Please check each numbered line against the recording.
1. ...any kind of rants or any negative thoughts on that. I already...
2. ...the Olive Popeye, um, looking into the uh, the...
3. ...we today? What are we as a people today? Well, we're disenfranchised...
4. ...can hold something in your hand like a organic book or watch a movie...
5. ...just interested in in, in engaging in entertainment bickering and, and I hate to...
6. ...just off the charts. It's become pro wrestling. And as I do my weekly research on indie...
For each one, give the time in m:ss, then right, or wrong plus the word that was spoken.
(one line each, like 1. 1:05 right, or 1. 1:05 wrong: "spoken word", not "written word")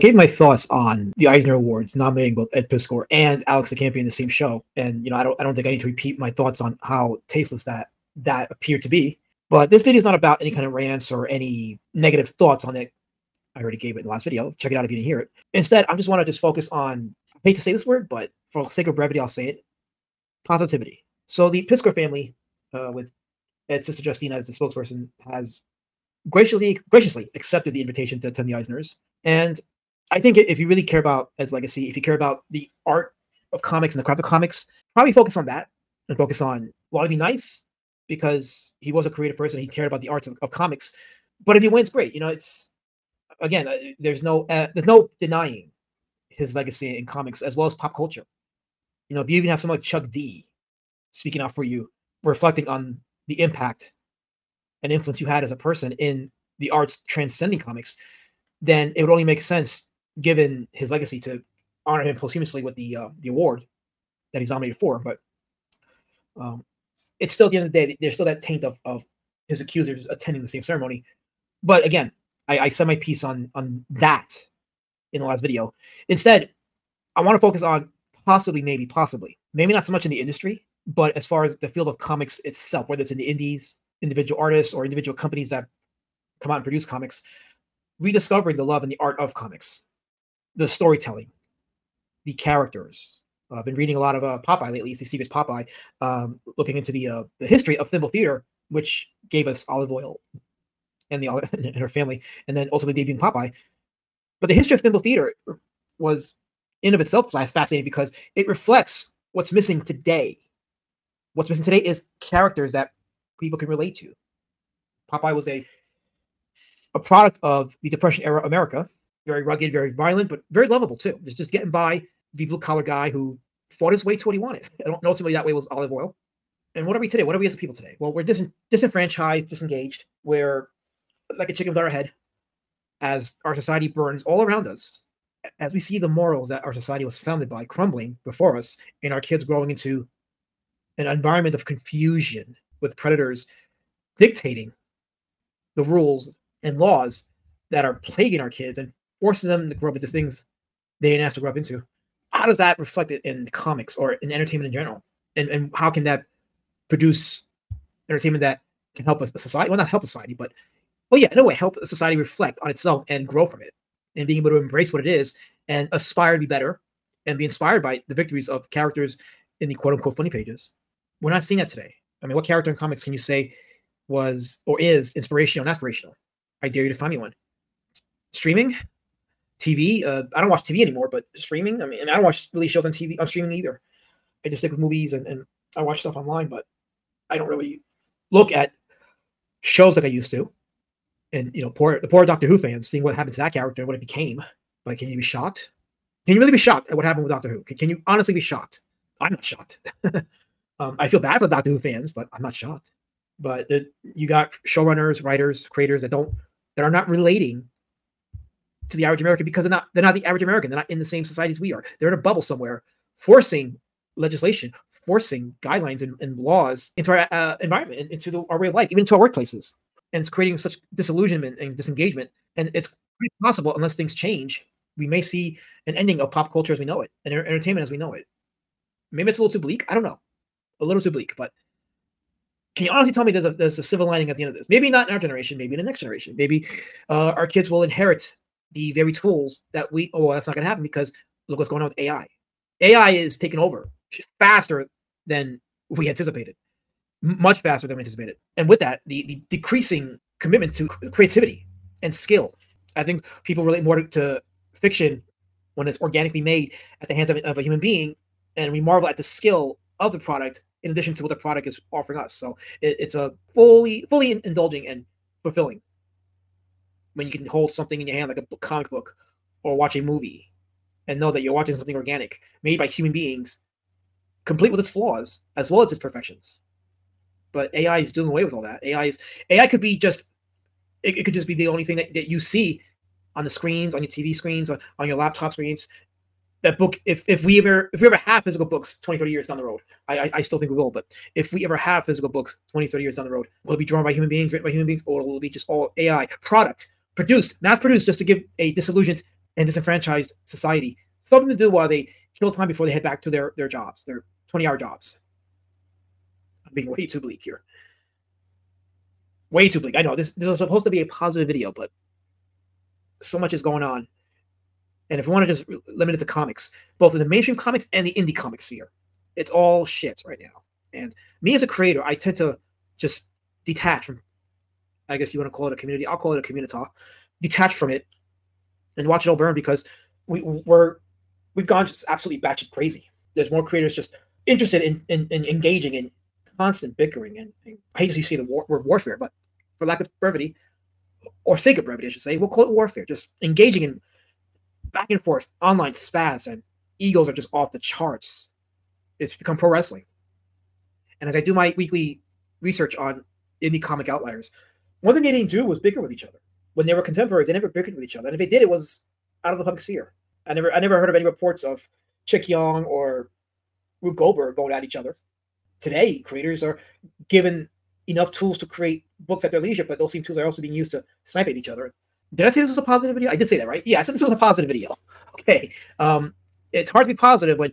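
1. 0:10 right
2. 1:34 wrong: "Secret", not "Olive"
3. 2:07 right
4. 4:27 wrong: "comic", not "organic"
5. 5:33 wrong: "constant", not "entertainment"
6. 5:47 right.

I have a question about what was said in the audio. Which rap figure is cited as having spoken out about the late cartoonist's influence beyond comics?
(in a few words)
Chuck D.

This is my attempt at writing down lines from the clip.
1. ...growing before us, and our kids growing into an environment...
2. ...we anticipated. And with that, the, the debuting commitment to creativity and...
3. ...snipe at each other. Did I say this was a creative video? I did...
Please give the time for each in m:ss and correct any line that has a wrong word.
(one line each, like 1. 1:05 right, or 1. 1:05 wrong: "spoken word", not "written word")
1. 2:17 wrong: "crumbling", not "growing"
2. 4:07 wrong: "decreasing", not "debuting"
3. 6:11 wrong: "positive", not "creative".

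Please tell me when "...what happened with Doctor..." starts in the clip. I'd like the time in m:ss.
3:16.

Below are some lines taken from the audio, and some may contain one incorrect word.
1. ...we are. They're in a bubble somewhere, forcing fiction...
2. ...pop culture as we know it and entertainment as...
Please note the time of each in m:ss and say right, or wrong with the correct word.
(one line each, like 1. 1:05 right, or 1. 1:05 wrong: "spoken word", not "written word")
1. 3:31 wrong: "legislation", not "fiction"
2. 3:46 right.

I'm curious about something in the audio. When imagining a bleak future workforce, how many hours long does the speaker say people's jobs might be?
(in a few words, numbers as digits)
20.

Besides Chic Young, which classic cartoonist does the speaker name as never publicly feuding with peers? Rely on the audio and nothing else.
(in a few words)
Rube Goldberg.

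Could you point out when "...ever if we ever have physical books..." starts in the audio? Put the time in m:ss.
4:47.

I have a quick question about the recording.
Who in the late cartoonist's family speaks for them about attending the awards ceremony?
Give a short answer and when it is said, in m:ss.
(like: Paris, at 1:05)
Justina, at 0:24.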